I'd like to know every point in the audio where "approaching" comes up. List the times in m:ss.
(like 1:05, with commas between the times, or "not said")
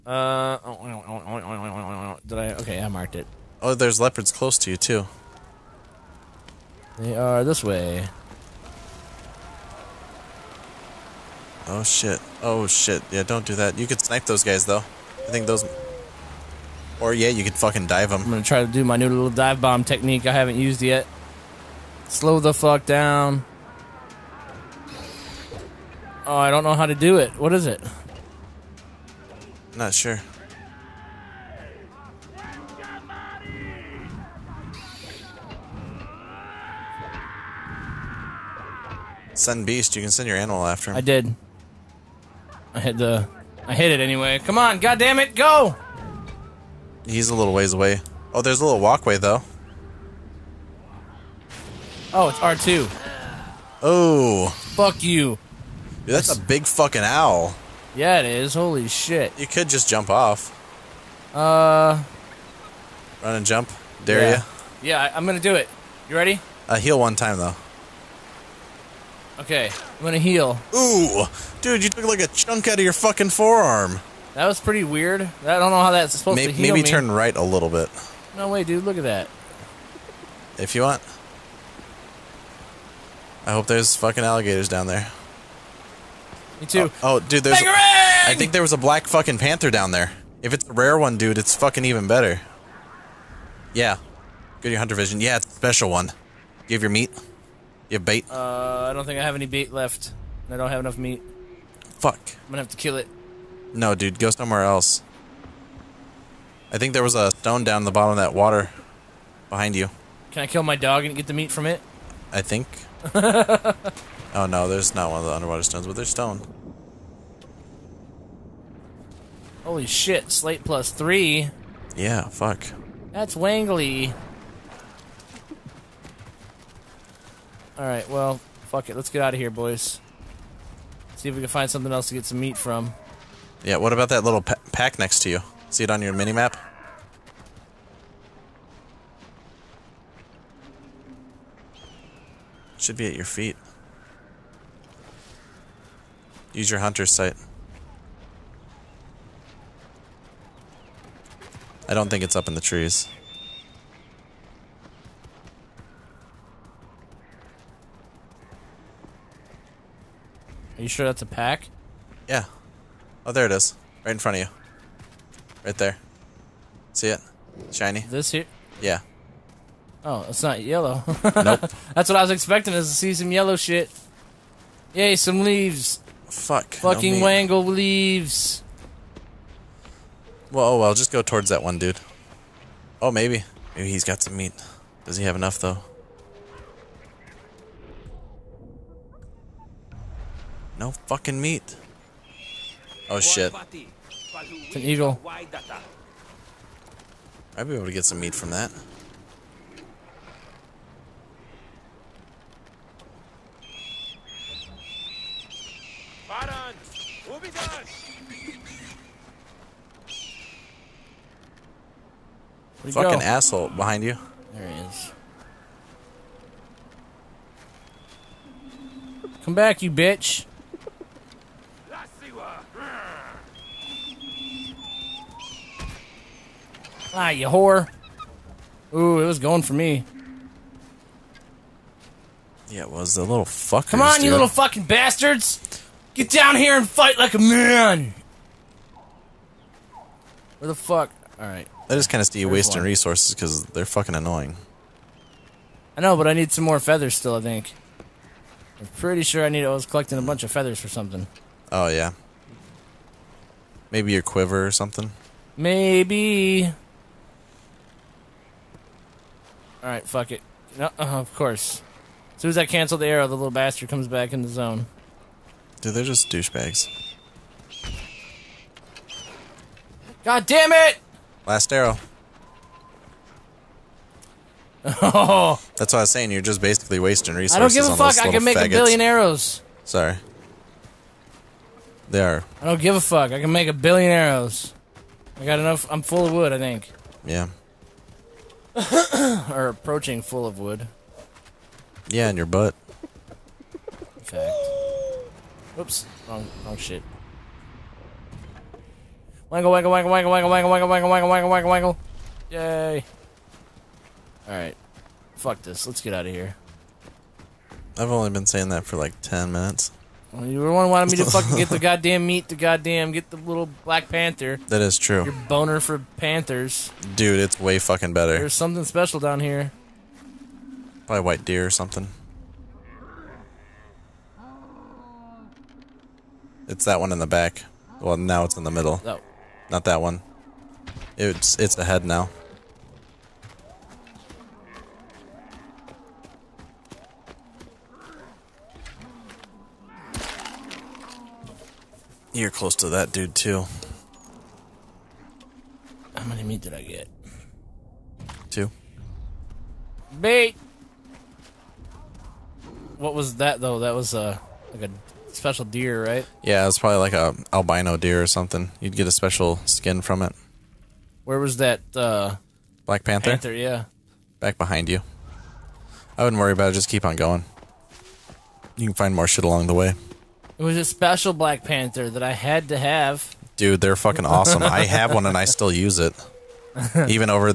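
4:49.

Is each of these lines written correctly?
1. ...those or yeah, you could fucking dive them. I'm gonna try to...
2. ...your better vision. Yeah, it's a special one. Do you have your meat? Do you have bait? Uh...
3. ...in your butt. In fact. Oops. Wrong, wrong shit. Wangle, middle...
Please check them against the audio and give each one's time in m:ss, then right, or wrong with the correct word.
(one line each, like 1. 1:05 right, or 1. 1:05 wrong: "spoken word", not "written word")
1. 0:15 right
2. 1:34 wrong: "hunter", not "better"
3. 4:52 wrong: "wangle", not "middle".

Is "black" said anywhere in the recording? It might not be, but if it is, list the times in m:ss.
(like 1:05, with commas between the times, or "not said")
1:28, 5:13, 6:02, 6:11.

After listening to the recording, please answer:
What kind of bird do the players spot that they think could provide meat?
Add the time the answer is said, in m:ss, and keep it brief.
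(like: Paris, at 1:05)
eagle, at 3:14.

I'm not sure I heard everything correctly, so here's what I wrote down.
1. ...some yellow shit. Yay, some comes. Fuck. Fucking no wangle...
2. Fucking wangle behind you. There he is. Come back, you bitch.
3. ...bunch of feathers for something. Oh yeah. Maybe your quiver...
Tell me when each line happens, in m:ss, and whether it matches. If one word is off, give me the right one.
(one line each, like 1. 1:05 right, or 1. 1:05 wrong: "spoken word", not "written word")
1. 2:53 wrong: "leaves", not "comes"
2. 3:32 wrong: "asshole", not "wangle"
3. 4:10 right.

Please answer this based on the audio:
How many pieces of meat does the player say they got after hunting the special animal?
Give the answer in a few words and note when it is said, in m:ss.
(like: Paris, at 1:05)
2, at 5:48.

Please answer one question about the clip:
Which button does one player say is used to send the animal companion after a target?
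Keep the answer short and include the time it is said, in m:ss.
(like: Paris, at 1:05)
R2, at 0:52.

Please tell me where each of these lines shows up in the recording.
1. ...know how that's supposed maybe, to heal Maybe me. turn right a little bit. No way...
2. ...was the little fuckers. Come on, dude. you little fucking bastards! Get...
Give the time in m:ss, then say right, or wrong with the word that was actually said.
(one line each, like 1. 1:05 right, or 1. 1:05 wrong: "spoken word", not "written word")
1. 1:15 right
2. 3:52 right.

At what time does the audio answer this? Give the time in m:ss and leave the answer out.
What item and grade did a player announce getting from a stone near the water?
2:00.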